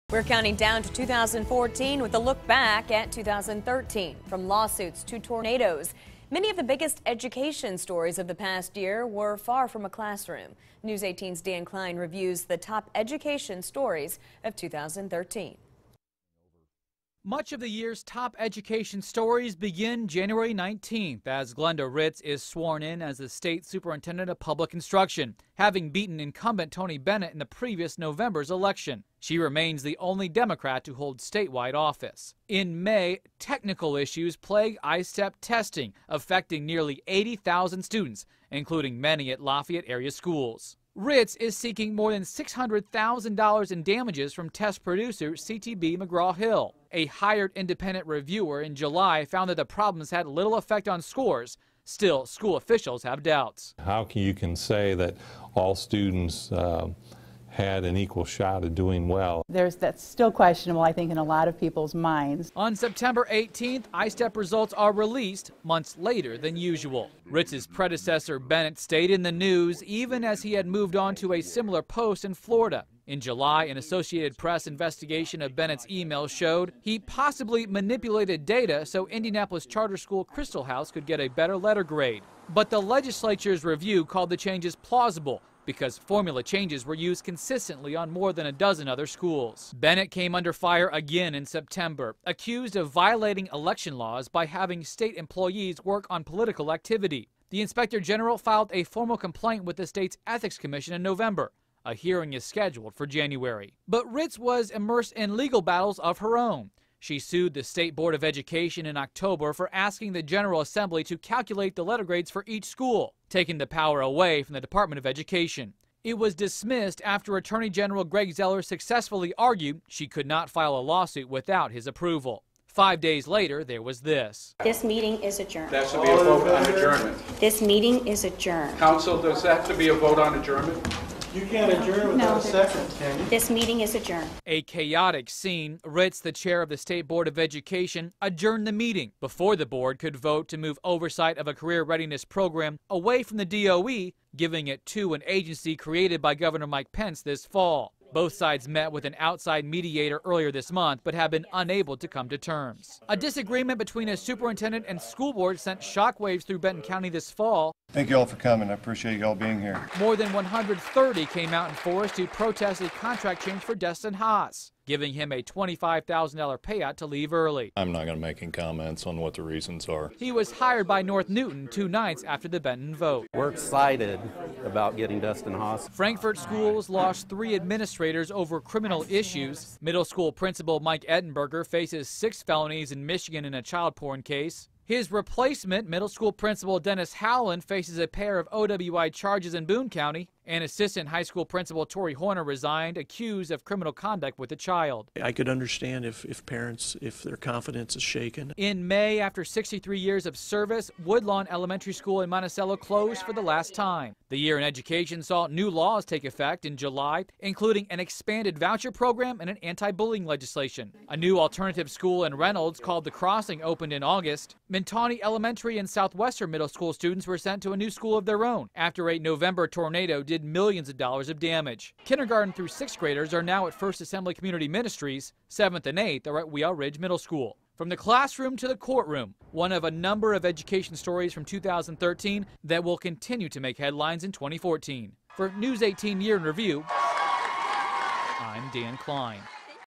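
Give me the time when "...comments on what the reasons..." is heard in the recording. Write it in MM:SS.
02:48.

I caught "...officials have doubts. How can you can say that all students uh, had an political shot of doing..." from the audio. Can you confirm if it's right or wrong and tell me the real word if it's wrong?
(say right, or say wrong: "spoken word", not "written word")
wrong: "equal", not "political".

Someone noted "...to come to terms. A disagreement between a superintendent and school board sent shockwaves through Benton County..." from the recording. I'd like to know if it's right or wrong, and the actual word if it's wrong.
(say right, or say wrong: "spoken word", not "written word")
right.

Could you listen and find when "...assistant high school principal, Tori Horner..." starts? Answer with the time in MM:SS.
03:10.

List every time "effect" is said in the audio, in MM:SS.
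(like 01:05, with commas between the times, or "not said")
00:50, 03:26.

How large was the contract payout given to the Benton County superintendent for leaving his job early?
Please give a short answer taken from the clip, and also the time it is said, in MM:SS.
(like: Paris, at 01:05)
$25,000, at 02:45.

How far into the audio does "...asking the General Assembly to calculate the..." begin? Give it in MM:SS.
01:49.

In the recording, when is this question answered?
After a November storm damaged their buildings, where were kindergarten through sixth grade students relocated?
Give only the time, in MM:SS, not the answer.
03:43.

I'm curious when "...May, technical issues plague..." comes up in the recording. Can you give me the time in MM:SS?
00:32.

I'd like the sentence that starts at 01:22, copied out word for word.
But the legislature's review called the changes plausible because formula changes were used consistently on more than a dozen other schools.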